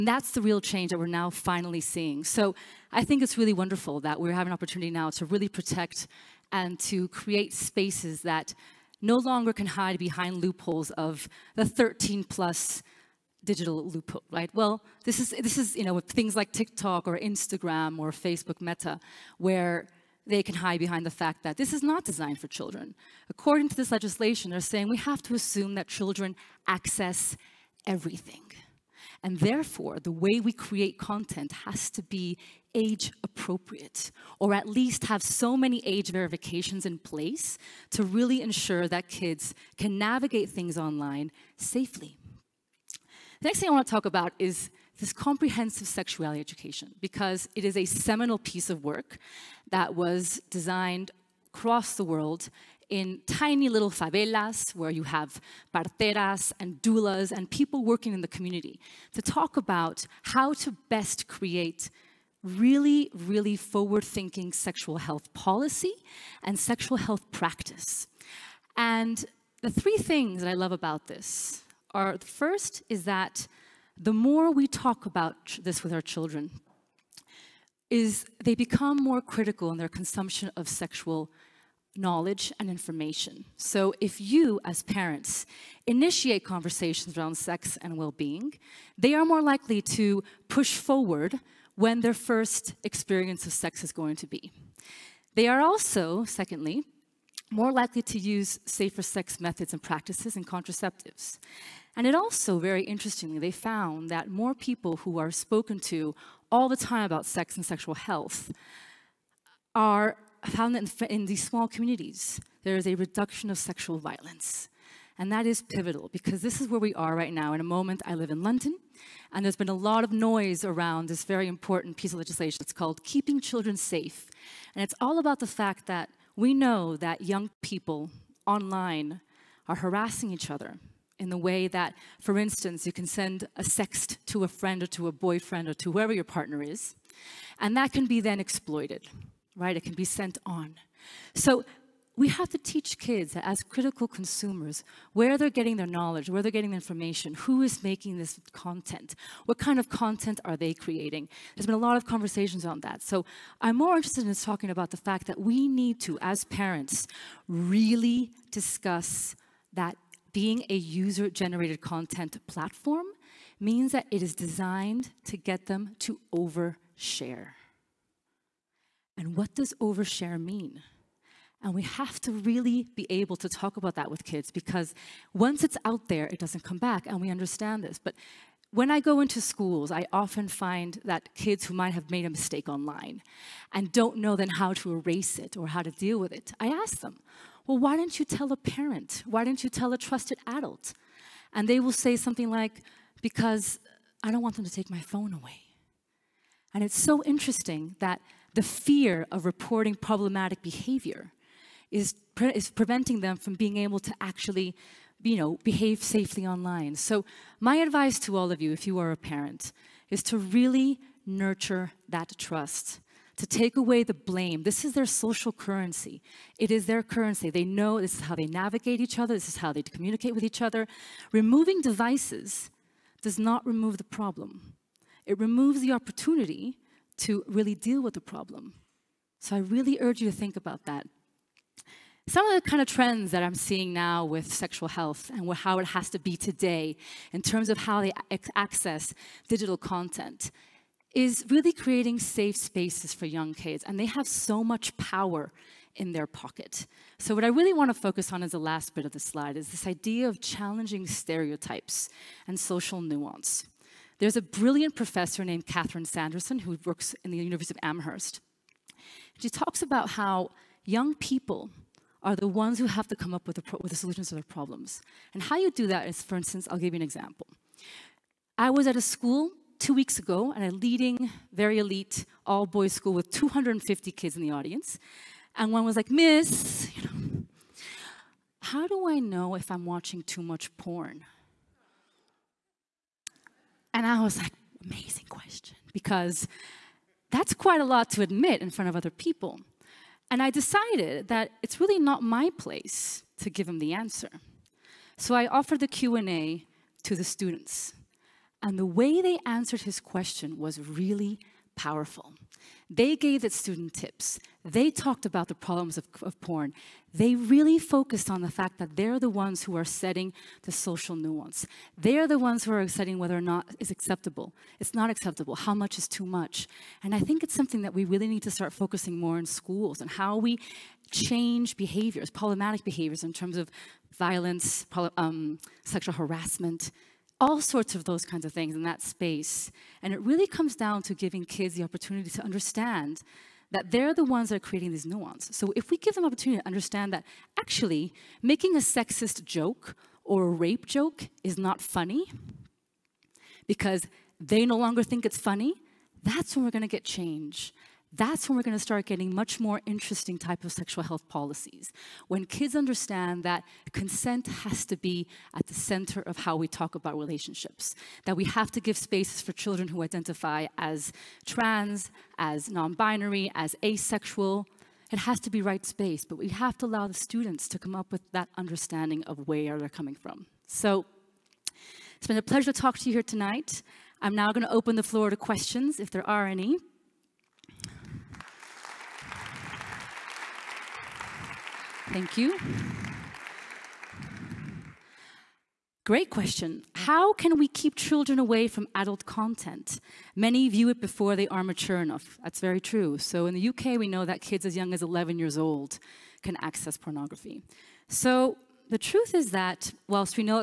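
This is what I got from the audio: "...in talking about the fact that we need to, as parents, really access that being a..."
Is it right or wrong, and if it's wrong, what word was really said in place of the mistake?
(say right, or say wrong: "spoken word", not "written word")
wrong: "discuss", not "access".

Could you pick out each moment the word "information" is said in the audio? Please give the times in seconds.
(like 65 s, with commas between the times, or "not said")
82 s, 146 s.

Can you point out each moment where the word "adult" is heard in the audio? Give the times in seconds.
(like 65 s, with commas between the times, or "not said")
190 s, 388 s.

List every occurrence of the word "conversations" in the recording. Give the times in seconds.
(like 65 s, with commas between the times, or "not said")
86 s, 152 s.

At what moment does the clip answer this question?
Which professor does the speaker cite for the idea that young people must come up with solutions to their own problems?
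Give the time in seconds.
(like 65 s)
255 s.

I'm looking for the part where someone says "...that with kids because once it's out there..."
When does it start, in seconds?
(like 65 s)
173 s.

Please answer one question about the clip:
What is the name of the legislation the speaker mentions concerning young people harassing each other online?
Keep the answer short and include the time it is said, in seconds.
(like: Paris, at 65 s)
Keeping Children Safe, at 123 s.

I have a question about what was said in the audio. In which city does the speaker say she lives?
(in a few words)
London.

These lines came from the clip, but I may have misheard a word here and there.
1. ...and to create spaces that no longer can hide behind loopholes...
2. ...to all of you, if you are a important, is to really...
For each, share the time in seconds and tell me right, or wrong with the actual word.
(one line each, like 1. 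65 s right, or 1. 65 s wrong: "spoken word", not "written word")
1. 6 s right
2. 208 s wrong: "parent", not "important".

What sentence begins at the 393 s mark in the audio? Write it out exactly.
So in the UK, we know that kids as young as 11 years old can access pornography.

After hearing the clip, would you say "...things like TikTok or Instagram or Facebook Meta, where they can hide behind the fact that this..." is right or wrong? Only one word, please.
right.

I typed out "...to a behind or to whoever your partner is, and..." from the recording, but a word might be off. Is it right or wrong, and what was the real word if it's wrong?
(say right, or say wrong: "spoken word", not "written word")
wrong: "boyfriend", not "behind".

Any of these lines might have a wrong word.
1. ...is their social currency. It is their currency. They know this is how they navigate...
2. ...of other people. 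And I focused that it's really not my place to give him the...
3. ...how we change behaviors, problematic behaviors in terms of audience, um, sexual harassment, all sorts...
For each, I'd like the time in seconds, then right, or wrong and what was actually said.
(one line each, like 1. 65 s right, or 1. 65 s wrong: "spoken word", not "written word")
1. 214 s right
2. 288 s wrong: "decided", not "focused"
3. 320 s wrong: "violence", not "audience".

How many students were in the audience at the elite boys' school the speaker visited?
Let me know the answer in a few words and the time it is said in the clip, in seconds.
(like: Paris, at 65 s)
250, at 273 s.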